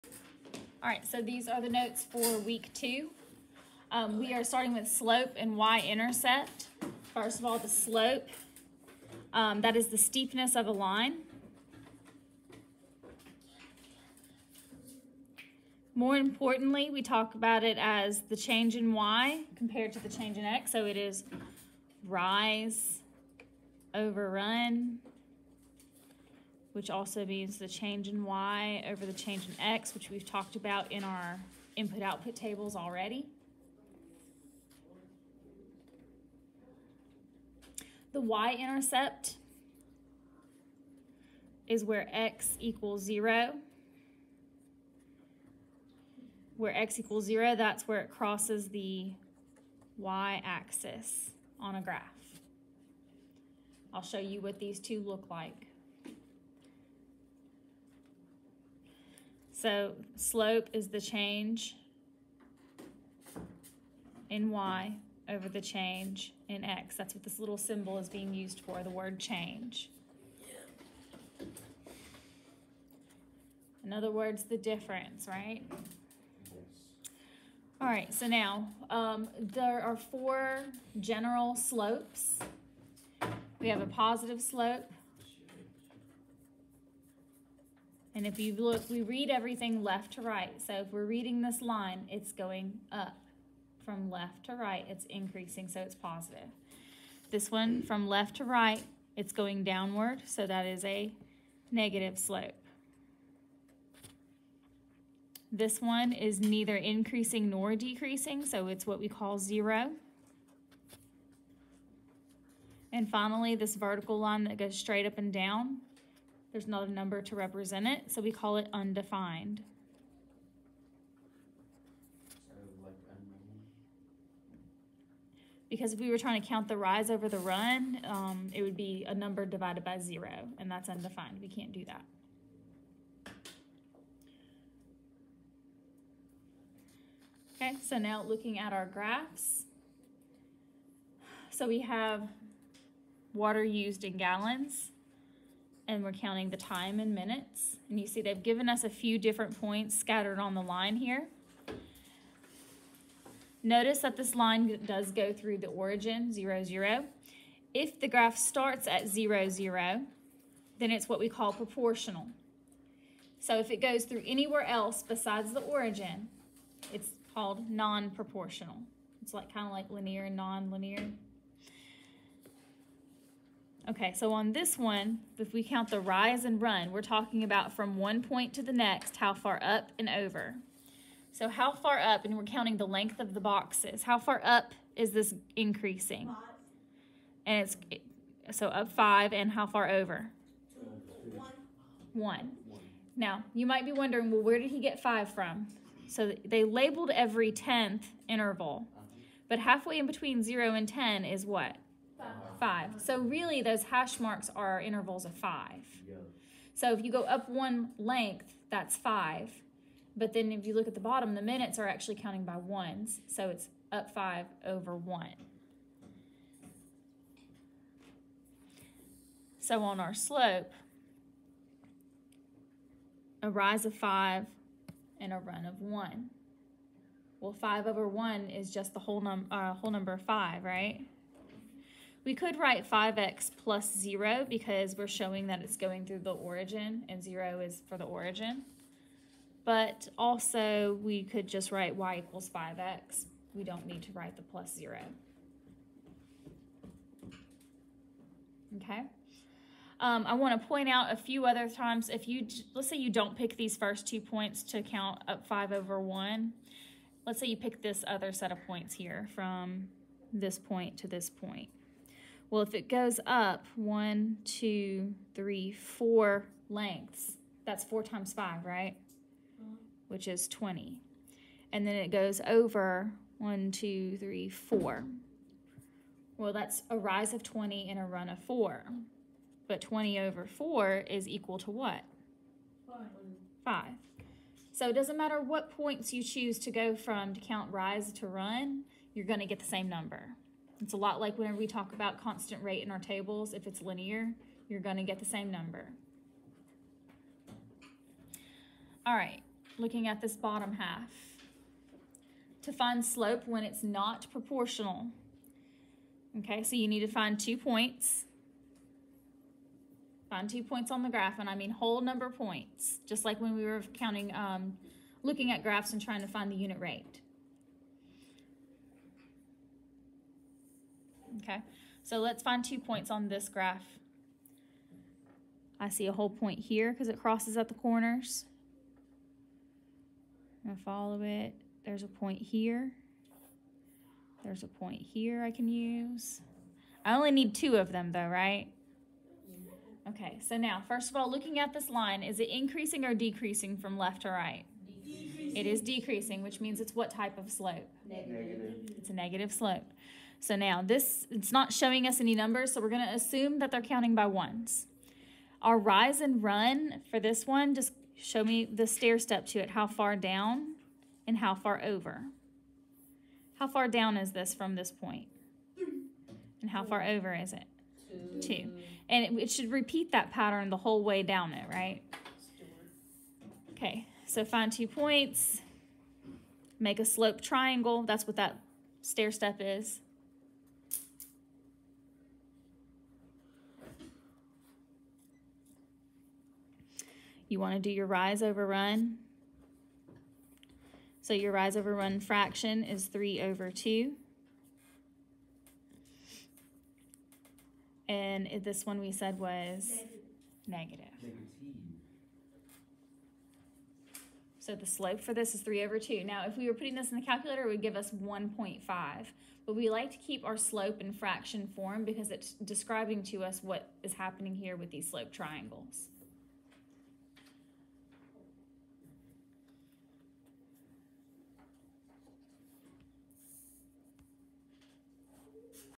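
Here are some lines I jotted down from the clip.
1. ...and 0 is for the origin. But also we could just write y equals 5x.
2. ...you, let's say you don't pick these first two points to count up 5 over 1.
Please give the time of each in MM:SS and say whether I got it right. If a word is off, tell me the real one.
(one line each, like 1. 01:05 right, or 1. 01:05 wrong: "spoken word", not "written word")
1. 03:57 right
2. 04:12 right.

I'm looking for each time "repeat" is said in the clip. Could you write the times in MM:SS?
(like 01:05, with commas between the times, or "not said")
06:09.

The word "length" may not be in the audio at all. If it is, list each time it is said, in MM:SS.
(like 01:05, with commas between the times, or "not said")
03:02, 03:27, 04:26.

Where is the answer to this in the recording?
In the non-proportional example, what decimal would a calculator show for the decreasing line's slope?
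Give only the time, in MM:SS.
06:48.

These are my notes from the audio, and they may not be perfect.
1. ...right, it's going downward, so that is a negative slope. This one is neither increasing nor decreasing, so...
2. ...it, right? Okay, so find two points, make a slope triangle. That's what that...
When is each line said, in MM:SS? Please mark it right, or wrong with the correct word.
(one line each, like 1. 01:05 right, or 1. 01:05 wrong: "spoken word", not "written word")
1. 01:38 right
2. 06:11 right.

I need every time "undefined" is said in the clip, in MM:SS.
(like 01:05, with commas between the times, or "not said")
01:58, 02:10.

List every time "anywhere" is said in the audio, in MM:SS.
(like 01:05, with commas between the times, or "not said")
02:44.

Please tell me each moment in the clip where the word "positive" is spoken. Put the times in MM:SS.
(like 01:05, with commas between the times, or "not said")
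01:23, 01:35.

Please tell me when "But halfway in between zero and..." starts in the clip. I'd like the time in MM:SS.
03:19.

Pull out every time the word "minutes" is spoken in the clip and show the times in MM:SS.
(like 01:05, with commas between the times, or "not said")
02:27, 03:31.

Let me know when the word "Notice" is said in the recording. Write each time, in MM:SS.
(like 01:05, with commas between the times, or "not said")
02:33.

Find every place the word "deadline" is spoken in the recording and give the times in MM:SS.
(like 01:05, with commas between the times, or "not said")
not said.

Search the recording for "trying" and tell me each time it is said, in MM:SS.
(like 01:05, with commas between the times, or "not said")
02:06, 05:16.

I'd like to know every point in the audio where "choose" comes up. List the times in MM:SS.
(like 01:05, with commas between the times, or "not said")
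04:46.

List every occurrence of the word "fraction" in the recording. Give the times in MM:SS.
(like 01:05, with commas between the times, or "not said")
06:32, 06:51.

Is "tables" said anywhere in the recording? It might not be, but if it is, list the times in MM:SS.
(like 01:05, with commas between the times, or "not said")
00:32, 04:52.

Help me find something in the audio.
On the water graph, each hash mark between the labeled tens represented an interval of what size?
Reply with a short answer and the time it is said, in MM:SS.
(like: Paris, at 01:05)
5, at 03:24.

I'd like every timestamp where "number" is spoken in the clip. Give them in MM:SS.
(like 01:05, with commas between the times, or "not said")
01:56, 02:09, 03:49, 04:49, 04:55, 05:12, 05:52.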